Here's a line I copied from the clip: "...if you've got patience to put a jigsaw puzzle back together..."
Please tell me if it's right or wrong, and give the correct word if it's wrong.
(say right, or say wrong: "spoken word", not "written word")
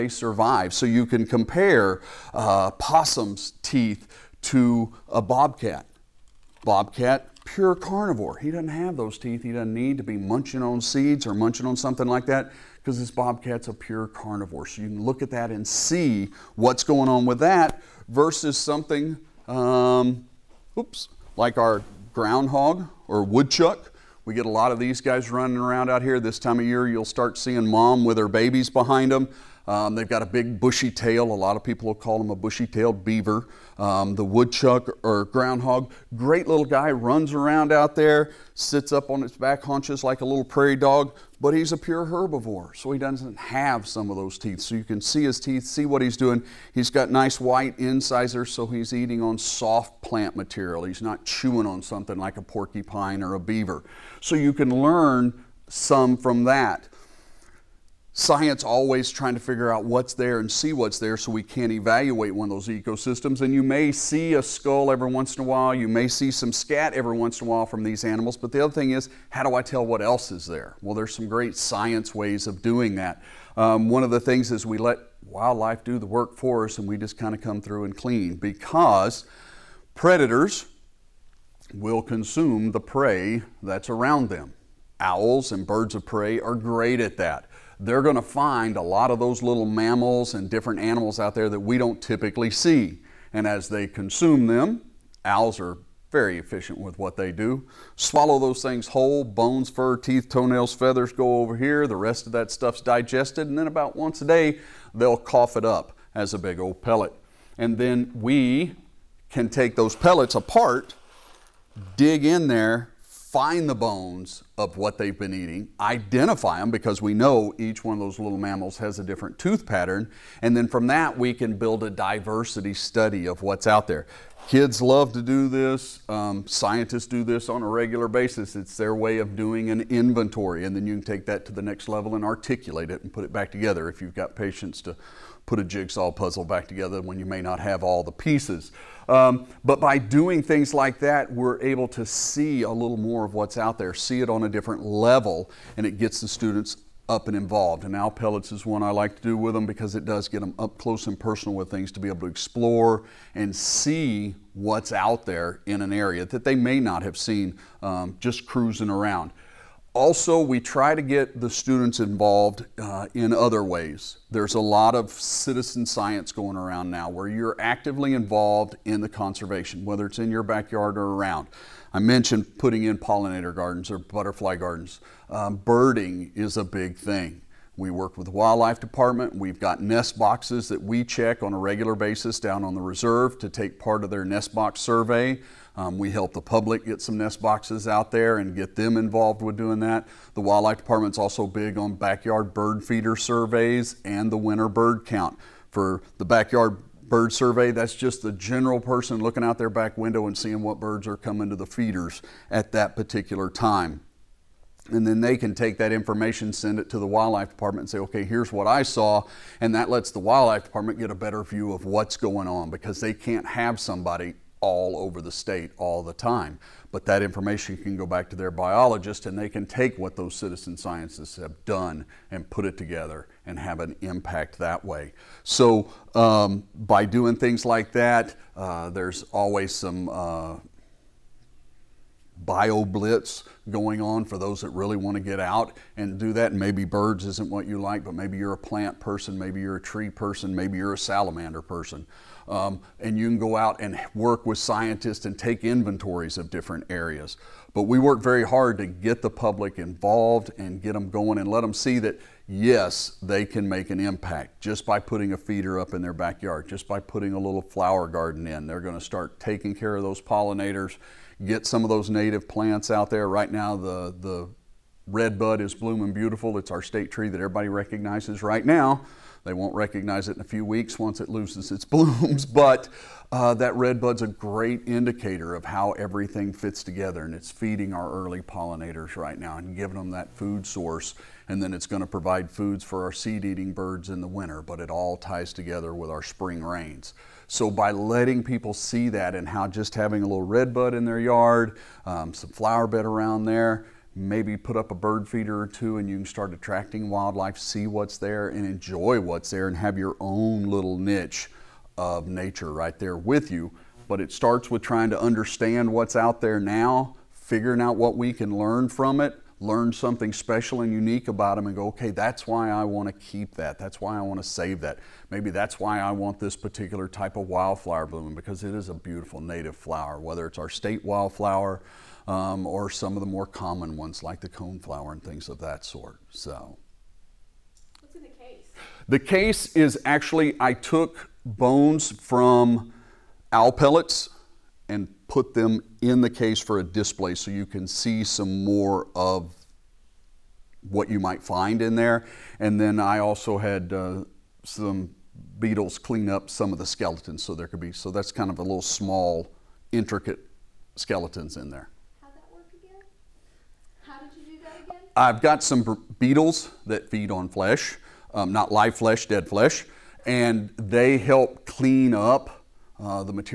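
right.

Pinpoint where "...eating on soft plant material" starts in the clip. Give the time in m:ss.
0:48.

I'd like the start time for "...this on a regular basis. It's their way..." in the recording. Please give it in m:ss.
2:07.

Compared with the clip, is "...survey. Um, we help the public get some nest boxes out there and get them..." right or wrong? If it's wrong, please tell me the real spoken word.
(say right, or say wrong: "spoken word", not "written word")
right.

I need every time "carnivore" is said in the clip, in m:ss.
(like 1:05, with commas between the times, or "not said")
0:07, 0:14.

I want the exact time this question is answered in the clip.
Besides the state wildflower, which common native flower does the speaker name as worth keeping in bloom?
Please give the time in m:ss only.
5:24.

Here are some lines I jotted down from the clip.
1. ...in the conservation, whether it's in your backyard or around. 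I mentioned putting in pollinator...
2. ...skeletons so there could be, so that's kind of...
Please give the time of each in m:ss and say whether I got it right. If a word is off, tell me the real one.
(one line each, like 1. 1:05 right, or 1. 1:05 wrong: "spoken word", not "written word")
1. 2:48 right
2. 5:46 right.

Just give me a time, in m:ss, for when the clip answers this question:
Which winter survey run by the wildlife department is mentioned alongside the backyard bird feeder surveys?
3:14.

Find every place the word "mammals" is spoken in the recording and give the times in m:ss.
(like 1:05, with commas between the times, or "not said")
1:29, 1:58.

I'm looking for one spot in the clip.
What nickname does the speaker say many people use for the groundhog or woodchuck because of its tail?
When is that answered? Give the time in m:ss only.
0:32.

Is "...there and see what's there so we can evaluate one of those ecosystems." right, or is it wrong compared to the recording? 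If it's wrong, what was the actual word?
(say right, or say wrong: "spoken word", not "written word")
right.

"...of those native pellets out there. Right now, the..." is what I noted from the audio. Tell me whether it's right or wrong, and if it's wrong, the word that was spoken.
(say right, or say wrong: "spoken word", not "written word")
wrong: "plants", not "pellets".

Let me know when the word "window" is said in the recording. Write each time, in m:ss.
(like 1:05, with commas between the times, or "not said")
3:19.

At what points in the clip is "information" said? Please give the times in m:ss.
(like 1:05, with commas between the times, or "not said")
3:25, 3:37.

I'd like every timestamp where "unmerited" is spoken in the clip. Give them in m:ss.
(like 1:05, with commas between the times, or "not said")
not said.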